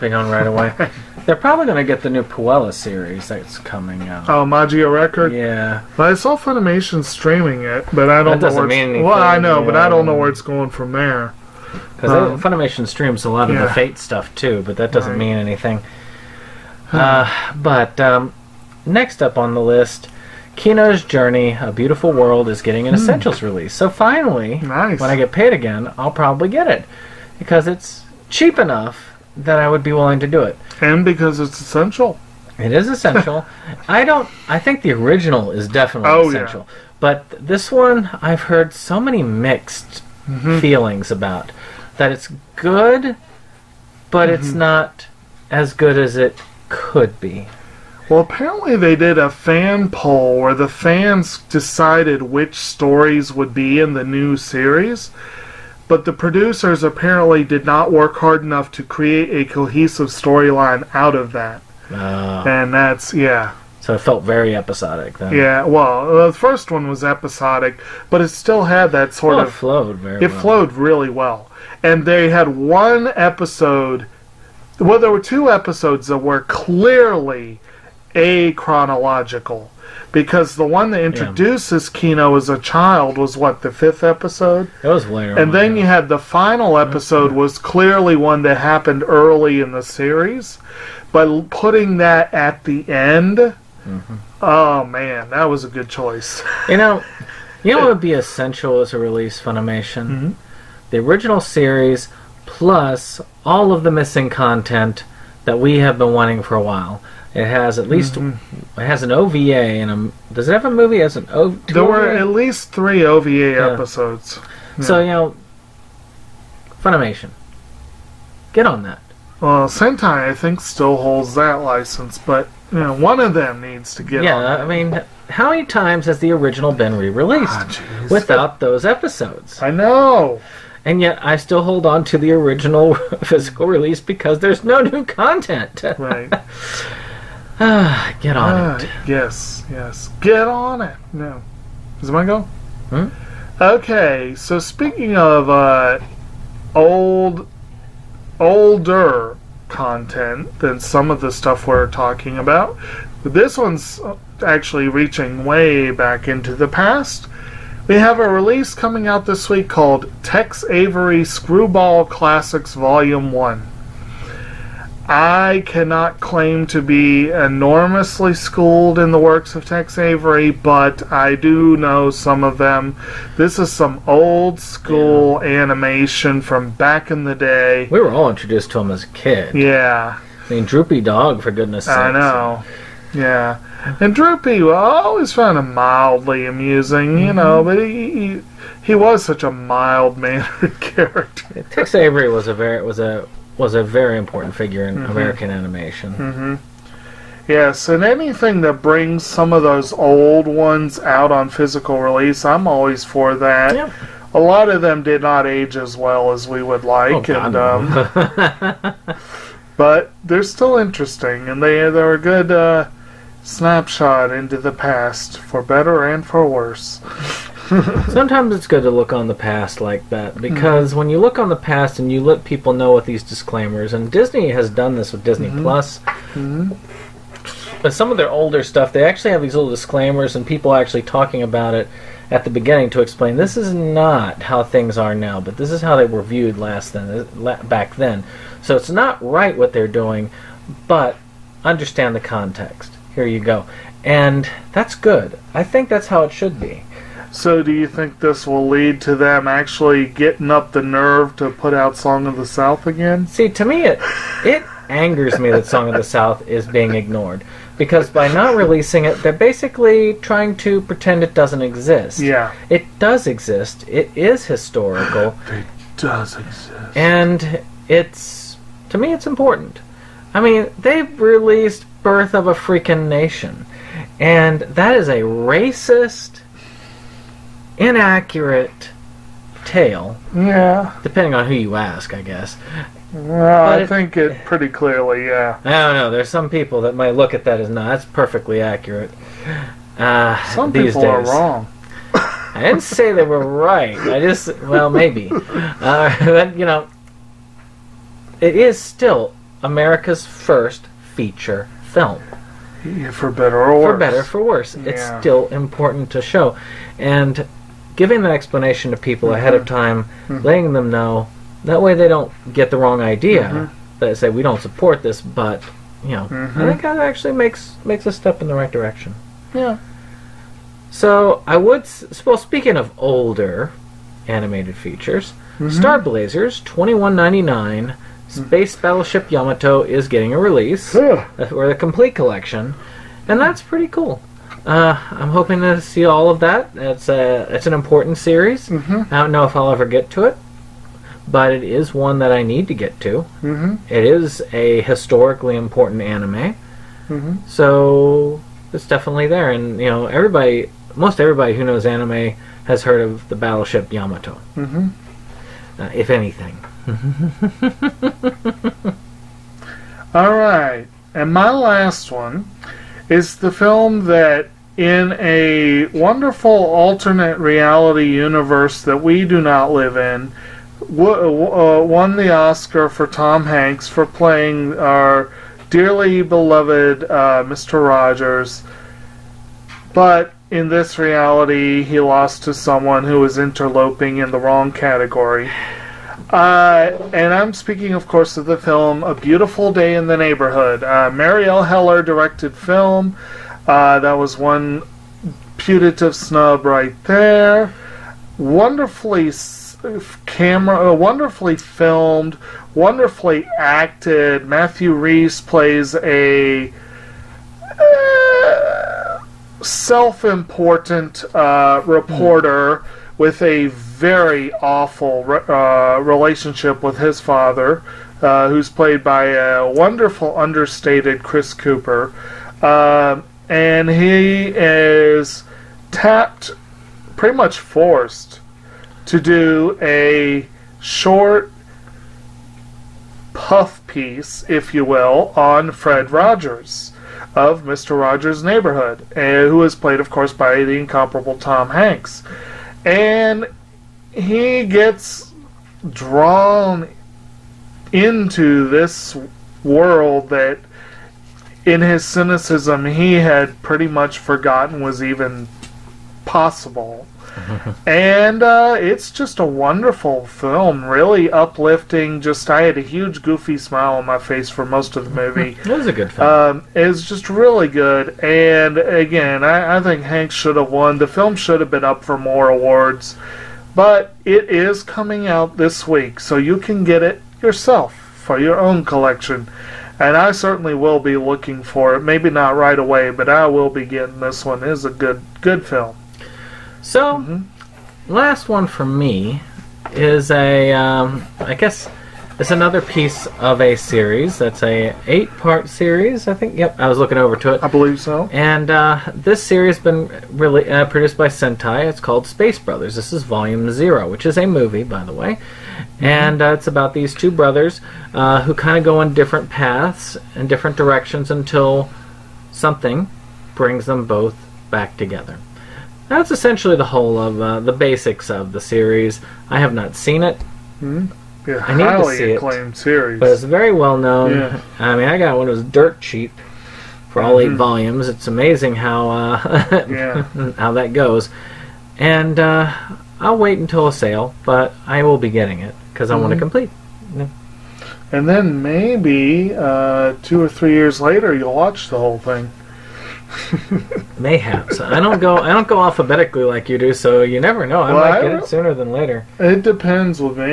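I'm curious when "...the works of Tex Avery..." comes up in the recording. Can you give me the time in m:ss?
2:49.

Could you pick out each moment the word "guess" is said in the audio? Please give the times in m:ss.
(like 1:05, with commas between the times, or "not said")
4:42, 8:11.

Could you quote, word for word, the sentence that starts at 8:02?
Maybe not right away, but I will be getting this one.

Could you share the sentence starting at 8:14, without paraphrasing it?
That's a eight part series, I think.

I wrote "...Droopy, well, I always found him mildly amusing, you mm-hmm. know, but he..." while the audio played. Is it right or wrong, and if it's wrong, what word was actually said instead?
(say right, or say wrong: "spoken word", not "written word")
right.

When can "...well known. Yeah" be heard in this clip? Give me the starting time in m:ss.
8:43.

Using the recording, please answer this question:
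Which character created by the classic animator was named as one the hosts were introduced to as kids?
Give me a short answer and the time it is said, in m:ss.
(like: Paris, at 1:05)
Droopy Dog, at 3:00.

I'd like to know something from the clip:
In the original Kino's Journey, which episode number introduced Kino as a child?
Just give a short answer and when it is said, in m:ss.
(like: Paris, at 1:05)
5th, at 1:23.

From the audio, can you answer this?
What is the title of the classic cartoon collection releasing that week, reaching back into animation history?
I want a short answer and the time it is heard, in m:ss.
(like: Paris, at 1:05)
Tex Avery Screwball Classics Volume 1, at 2:40.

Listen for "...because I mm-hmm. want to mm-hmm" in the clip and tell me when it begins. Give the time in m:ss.
8:55.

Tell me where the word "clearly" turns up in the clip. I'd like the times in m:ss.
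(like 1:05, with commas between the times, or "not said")
1:16, 1:27, 4:44.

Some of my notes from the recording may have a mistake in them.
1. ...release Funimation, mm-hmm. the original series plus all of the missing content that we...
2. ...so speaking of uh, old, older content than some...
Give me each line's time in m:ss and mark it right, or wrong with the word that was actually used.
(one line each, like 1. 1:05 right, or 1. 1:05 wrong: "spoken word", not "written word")
1. 1:38 right
2. 2:24 right.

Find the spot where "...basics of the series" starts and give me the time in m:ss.
8:37.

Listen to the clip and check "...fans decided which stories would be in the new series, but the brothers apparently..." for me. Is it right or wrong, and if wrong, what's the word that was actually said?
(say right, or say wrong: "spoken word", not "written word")
wrong: "producers", not "brothers".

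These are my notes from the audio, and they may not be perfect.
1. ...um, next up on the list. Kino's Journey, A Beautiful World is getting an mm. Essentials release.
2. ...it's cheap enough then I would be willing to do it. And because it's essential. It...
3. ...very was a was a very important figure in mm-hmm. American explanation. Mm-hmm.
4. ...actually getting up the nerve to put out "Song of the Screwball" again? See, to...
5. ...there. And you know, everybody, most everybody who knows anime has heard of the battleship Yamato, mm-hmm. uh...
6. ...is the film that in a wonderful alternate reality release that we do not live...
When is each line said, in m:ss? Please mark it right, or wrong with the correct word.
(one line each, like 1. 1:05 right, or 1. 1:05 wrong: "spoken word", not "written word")
1. 0:17 right
2. 0:27 right
3. 3:12 wrong: "animation", not "explanation"
4. 4:09 wrong: "South", not "Screwball"
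5. 5:49 right
6. 6:03 wrong: "universe", not "release".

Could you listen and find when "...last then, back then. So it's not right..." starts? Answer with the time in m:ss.
3:56.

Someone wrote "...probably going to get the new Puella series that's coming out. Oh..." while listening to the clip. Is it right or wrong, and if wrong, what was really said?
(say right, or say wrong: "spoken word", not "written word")
right.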